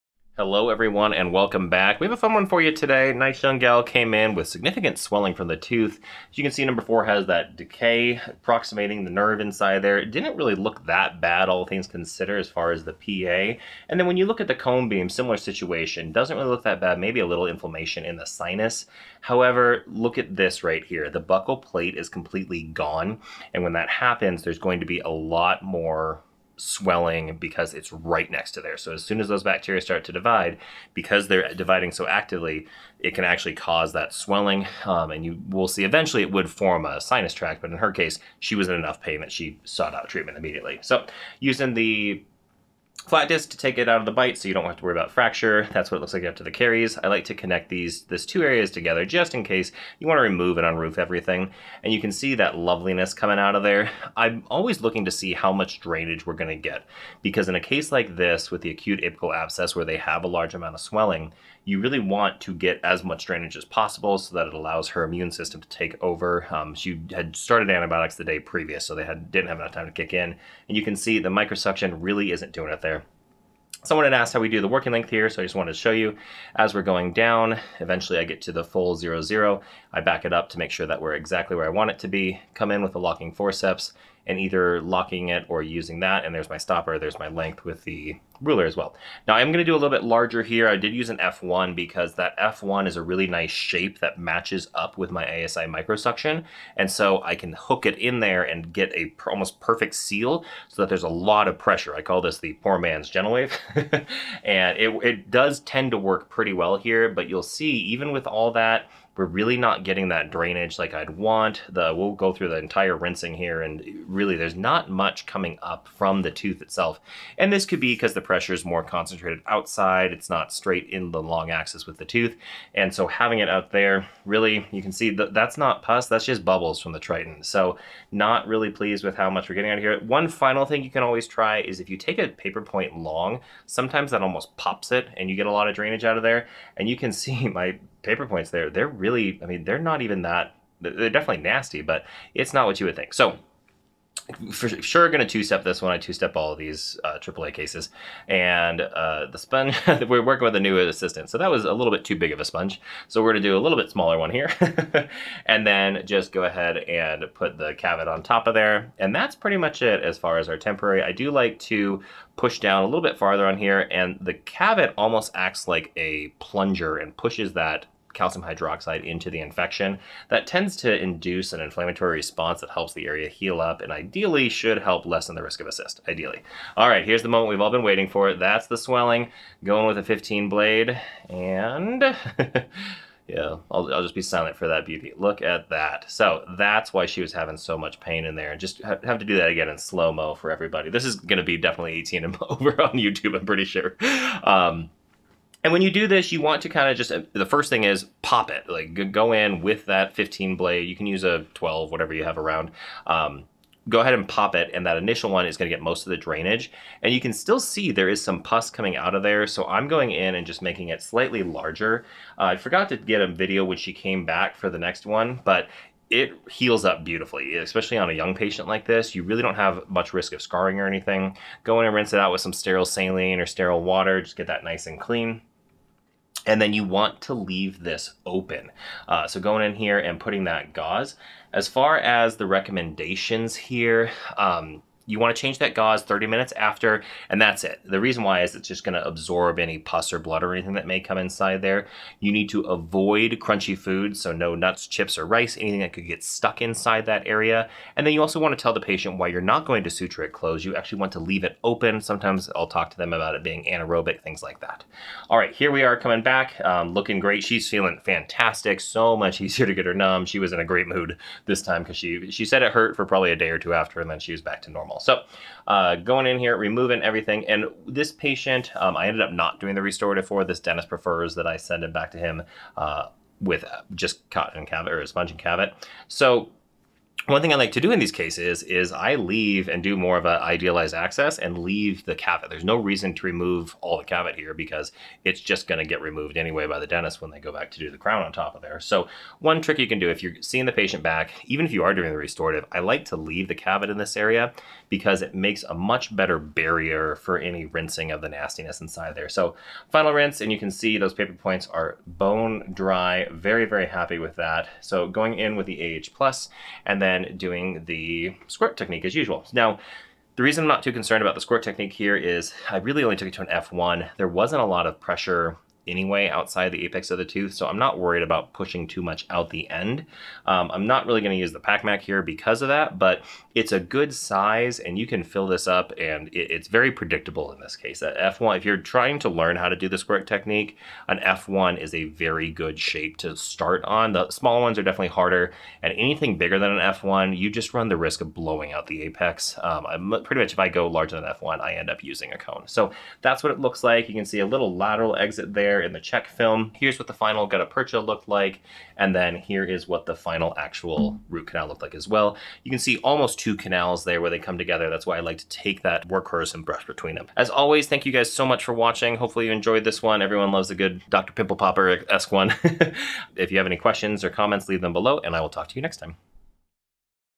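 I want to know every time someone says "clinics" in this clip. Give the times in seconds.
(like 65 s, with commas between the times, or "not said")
not said.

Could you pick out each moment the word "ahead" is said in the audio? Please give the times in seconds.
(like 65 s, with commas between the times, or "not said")
156 s, 203 s.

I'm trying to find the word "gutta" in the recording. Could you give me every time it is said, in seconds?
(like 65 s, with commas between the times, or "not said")
347 s.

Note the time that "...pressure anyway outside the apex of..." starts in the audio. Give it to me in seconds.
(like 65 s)
314 s.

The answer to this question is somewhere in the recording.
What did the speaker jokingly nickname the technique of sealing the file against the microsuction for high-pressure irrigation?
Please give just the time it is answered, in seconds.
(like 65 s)
102 s.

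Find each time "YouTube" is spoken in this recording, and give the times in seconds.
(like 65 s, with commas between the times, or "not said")
192 s.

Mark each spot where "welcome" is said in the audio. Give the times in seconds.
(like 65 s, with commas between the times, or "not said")
1 s.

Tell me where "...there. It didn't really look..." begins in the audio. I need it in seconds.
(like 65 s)
9 s.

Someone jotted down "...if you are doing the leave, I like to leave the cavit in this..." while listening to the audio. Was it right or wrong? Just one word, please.
wrong.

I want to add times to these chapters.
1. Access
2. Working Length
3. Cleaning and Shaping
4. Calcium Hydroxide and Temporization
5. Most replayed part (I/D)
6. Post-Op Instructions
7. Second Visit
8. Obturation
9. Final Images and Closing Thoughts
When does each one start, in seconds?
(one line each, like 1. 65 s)
1. 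25 s
2. 74 s
3. 87 s
4. 142 s
5. 176 s
6. 232 s
7. 255 s
8. 304 s
9. 344 s.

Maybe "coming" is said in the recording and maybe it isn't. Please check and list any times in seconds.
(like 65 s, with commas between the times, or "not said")
53 s, 115 s, 208 s, 255 s.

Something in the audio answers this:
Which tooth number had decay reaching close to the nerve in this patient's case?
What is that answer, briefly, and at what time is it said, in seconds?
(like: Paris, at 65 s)
4, at 6 s.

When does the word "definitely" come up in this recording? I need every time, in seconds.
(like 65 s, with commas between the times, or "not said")
141 s, 191 s, 334 s.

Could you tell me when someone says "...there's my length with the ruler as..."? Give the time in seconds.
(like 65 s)
86 s.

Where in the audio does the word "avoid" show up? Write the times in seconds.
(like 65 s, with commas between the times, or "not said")
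242 s.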